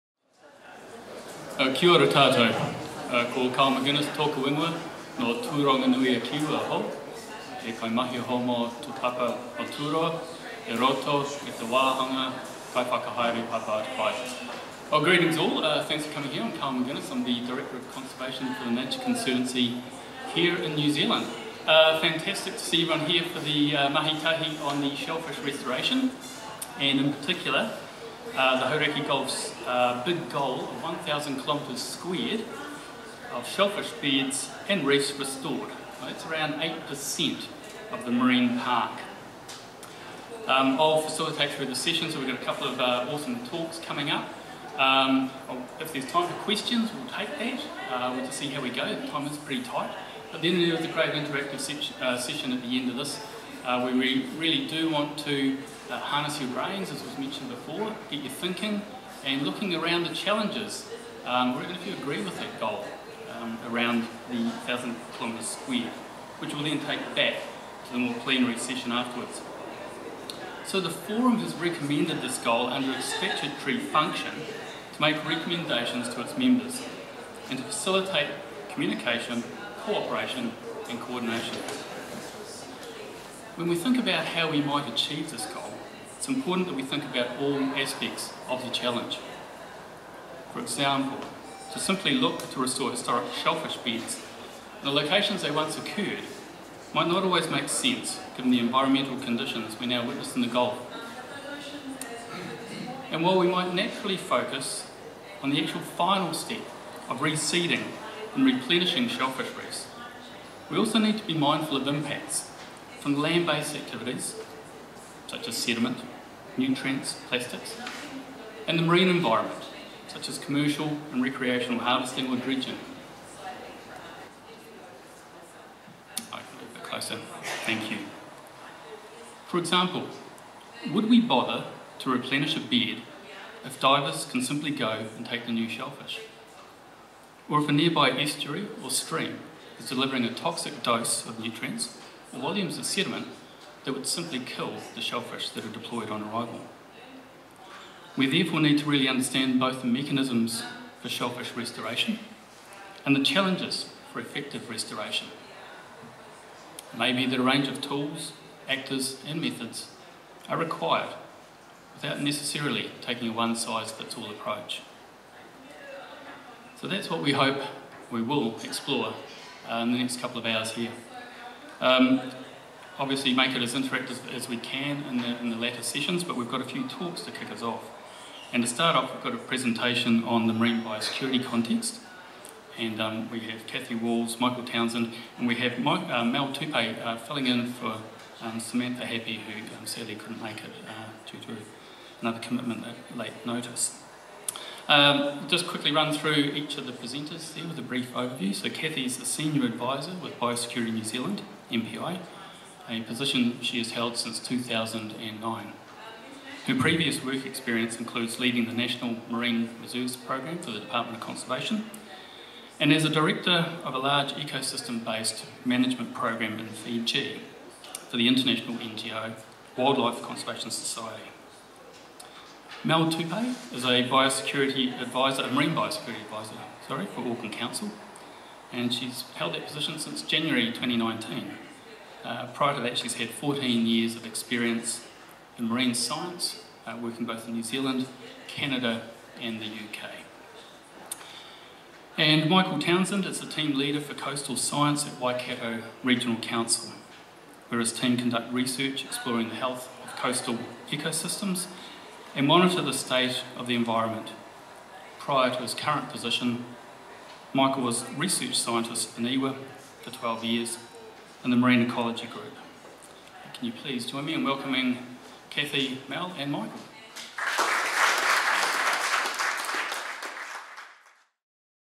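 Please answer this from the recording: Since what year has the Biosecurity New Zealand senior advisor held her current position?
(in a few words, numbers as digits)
2009.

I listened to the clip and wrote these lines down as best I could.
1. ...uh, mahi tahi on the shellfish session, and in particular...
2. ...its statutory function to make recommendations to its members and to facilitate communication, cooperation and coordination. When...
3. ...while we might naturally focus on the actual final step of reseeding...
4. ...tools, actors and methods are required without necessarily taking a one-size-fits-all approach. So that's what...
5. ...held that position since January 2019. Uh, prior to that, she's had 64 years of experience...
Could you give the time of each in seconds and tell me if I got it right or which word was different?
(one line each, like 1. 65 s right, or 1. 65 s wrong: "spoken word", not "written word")
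1. 23 s wrong: "restoration", not "session"
2. 72 s right
3. 103 s right
4. 157 s right
5. 229 s wrong: "14", not "64".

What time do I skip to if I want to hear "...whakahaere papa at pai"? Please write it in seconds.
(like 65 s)
12 s.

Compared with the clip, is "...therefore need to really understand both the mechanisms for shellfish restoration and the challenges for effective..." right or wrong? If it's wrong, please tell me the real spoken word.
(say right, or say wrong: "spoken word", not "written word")
right.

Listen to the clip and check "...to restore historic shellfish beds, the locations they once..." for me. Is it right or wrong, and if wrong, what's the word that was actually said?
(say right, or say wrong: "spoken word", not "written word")
right.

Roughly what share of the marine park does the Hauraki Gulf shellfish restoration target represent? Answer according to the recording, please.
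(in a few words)
8%.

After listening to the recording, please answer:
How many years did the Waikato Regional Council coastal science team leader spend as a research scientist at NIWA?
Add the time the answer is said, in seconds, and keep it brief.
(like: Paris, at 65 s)
12, at 260 s.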